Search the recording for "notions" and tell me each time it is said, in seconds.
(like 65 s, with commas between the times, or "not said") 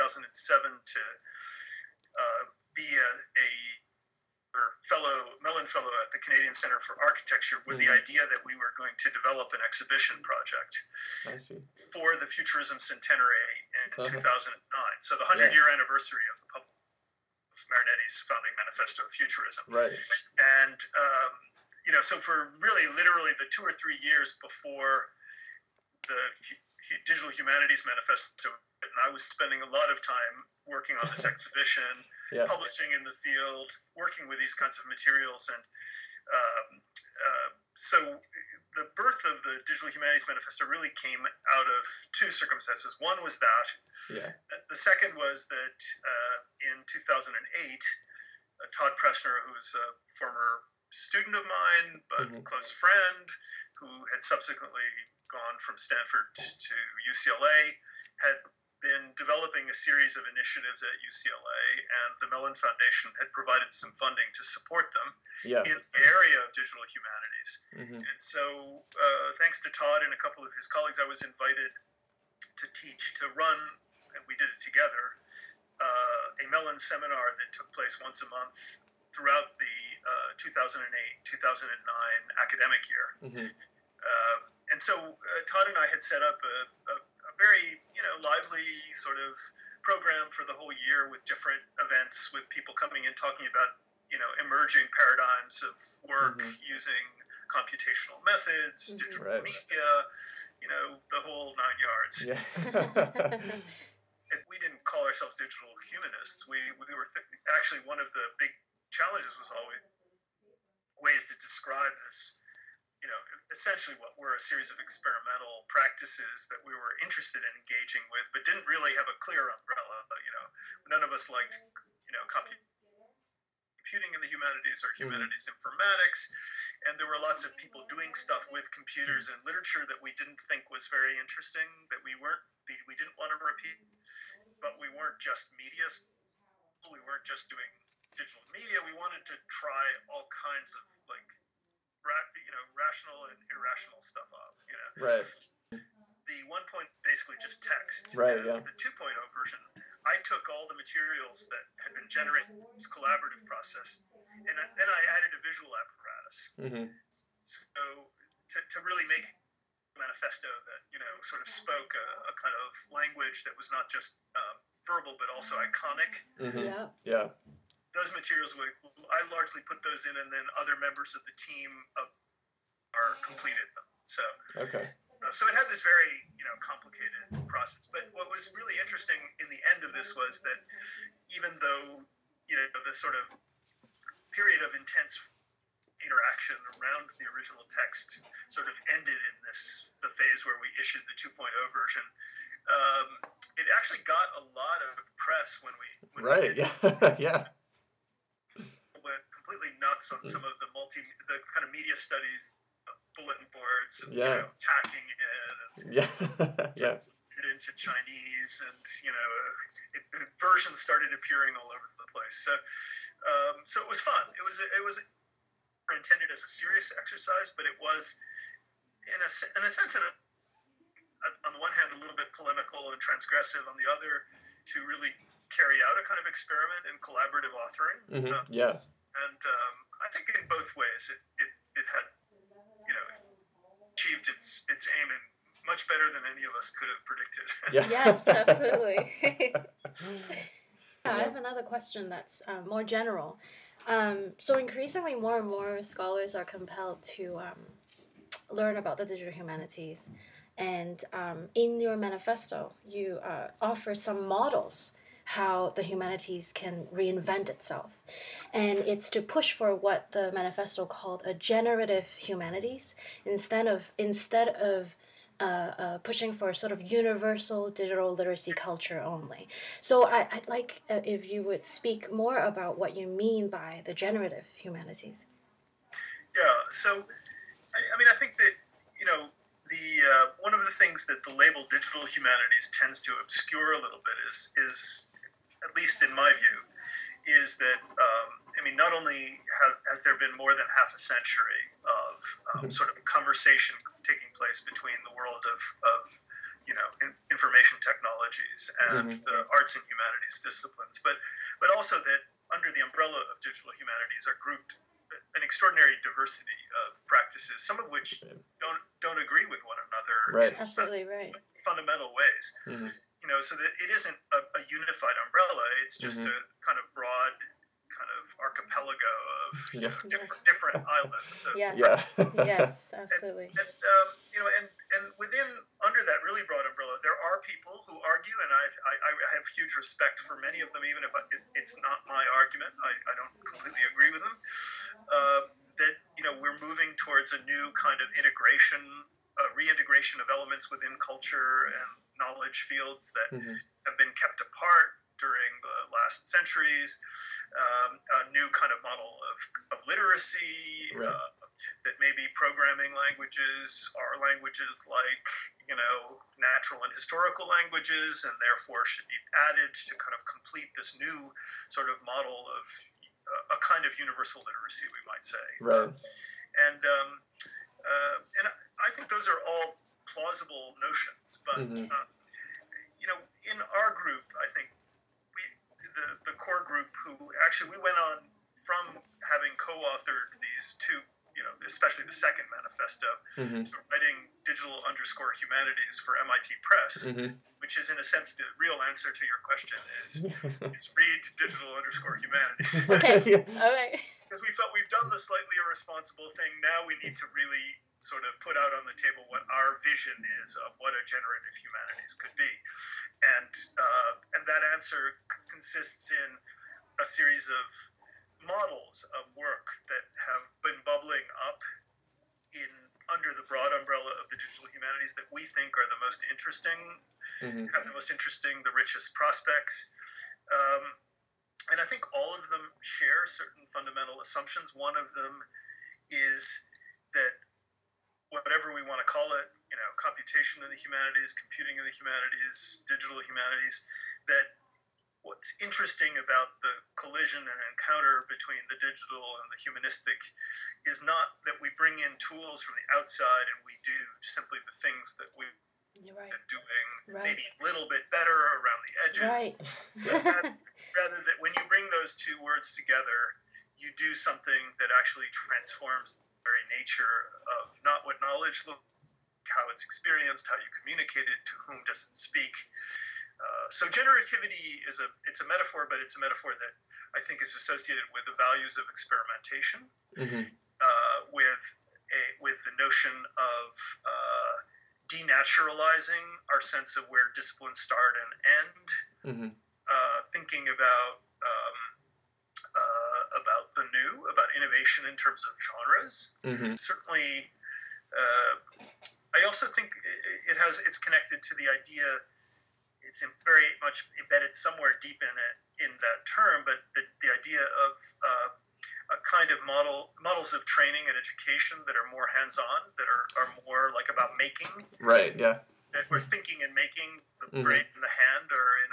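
370 s, 472 s.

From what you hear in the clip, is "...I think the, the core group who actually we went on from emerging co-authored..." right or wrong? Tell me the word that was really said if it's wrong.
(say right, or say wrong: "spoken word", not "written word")
wrong: "having", not "emerging".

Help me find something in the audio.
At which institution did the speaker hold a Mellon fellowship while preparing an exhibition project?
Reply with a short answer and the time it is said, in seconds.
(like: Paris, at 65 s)
Canadian Center for Architecture, at 6 s.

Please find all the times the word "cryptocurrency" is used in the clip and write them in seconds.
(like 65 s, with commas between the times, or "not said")
not said.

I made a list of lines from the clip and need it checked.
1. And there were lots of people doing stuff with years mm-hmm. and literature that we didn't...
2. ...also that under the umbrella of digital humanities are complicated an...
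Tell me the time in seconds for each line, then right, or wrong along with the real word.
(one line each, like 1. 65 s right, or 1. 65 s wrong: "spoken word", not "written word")
1. 126 s wrong: "computers", not "years"
2. 301 s wrong: "grouped", not "complicated".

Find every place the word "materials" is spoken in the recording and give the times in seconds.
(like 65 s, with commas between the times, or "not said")
34 s, 150 s, 168 s.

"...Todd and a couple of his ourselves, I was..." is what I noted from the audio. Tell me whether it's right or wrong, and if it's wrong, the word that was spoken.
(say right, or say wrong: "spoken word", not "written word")
wrong: "colleagues", not "ourselves".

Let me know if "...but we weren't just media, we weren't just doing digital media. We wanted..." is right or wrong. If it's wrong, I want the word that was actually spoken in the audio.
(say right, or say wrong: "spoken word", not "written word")
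right.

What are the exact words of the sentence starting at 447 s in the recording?
maybe a little bit better around the edges right.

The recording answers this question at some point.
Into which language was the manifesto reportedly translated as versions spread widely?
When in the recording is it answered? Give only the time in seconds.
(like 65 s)
207 s.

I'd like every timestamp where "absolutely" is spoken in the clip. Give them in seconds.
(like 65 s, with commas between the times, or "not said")
238 s, 310 s, 322 s.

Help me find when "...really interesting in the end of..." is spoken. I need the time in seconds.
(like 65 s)
178 s.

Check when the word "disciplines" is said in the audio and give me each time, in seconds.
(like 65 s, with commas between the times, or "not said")
300 s, 477 s.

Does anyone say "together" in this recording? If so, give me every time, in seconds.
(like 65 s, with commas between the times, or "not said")
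74 s, 452 s.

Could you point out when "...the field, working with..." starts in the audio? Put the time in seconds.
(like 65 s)
33 s.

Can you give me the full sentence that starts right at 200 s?
some of the multi the kind of media studies uh, bulletin boards and yeah.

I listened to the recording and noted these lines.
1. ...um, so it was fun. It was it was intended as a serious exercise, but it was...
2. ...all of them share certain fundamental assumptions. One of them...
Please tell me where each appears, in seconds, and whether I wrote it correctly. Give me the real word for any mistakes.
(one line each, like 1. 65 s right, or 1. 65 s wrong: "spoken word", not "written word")
1. 212 s right
2. 422 s right.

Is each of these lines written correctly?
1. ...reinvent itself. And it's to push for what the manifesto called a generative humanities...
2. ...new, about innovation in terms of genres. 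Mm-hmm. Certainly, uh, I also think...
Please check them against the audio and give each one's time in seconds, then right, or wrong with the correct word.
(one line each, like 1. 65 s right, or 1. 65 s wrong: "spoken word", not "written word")
1. 256 s right
2. 483 s right.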